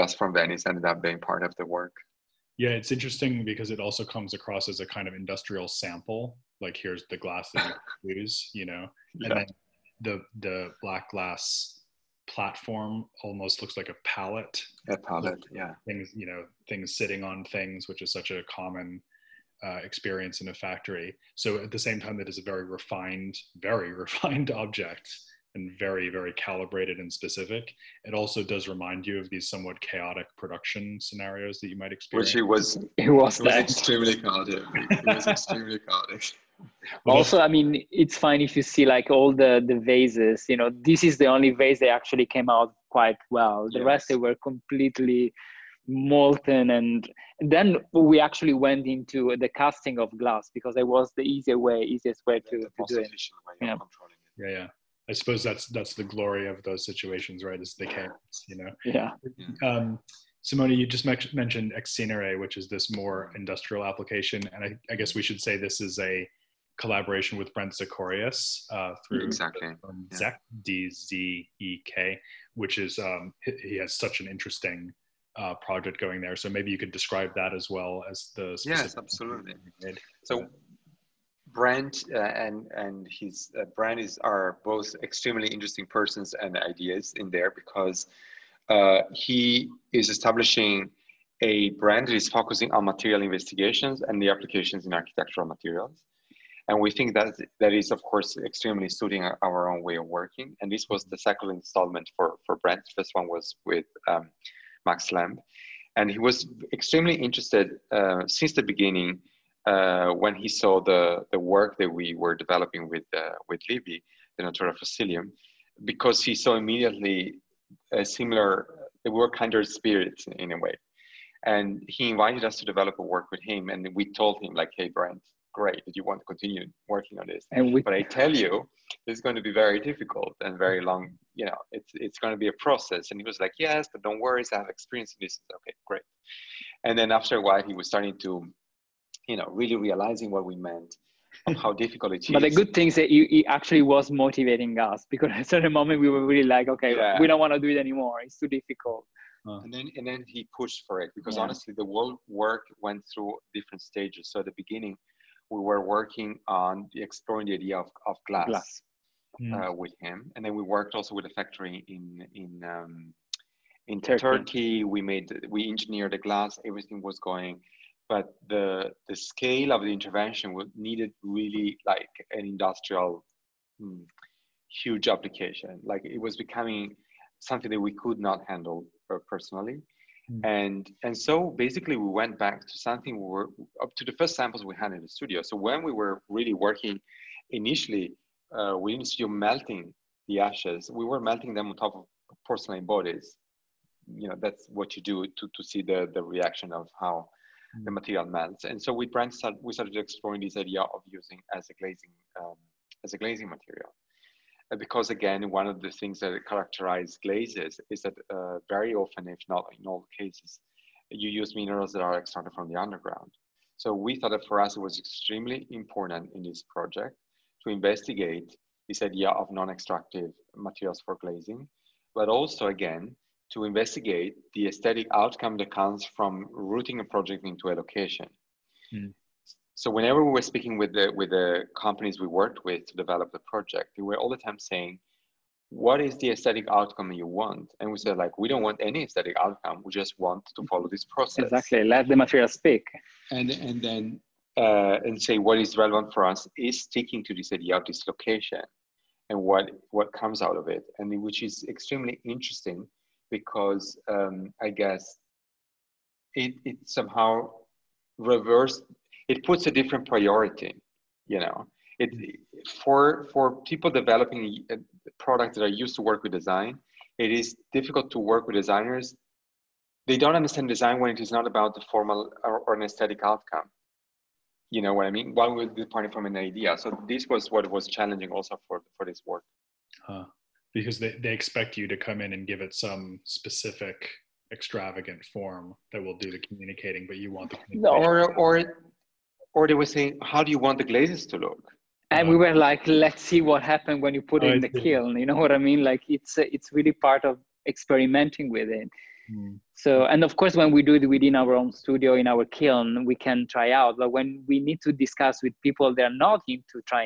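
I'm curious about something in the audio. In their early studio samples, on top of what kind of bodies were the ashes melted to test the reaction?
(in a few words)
Porcelain.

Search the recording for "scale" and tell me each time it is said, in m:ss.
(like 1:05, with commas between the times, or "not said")
2:49.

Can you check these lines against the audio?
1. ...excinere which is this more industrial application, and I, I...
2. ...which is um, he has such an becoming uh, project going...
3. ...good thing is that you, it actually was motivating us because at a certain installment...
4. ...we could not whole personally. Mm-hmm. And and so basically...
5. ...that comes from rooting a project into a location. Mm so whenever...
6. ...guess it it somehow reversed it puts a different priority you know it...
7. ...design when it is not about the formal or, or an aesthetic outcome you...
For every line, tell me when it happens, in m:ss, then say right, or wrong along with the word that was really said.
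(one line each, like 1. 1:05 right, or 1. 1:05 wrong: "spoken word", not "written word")
1. 1:01 right
2. 1:12 wrong: "interesting", not "becoming"
3. 2:22 wrong: "moment", not "installment"
4. 2:57 wrong: "handle", not "whole"
5. 3:45 right
6. 4:14 right
7. 4:30 right.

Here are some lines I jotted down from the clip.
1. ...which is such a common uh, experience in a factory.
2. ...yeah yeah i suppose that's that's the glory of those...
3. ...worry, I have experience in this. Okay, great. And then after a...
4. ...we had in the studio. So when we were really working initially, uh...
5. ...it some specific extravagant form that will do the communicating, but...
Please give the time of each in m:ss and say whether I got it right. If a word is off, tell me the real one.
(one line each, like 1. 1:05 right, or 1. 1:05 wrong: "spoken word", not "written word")
1. 0:17 right
2. 0:54 right
3. 2:14 right
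4. 3:04 right
5. 4:42 right.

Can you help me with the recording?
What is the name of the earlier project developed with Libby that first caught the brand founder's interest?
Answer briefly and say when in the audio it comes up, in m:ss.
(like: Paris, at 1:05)
Natura Fossilium, at 1:54.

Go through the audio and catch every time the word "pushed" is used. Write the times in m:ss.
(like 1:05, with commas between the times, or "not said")
2:30.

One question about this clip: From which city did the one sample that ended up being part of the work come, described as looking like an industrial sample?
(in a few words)
Venice.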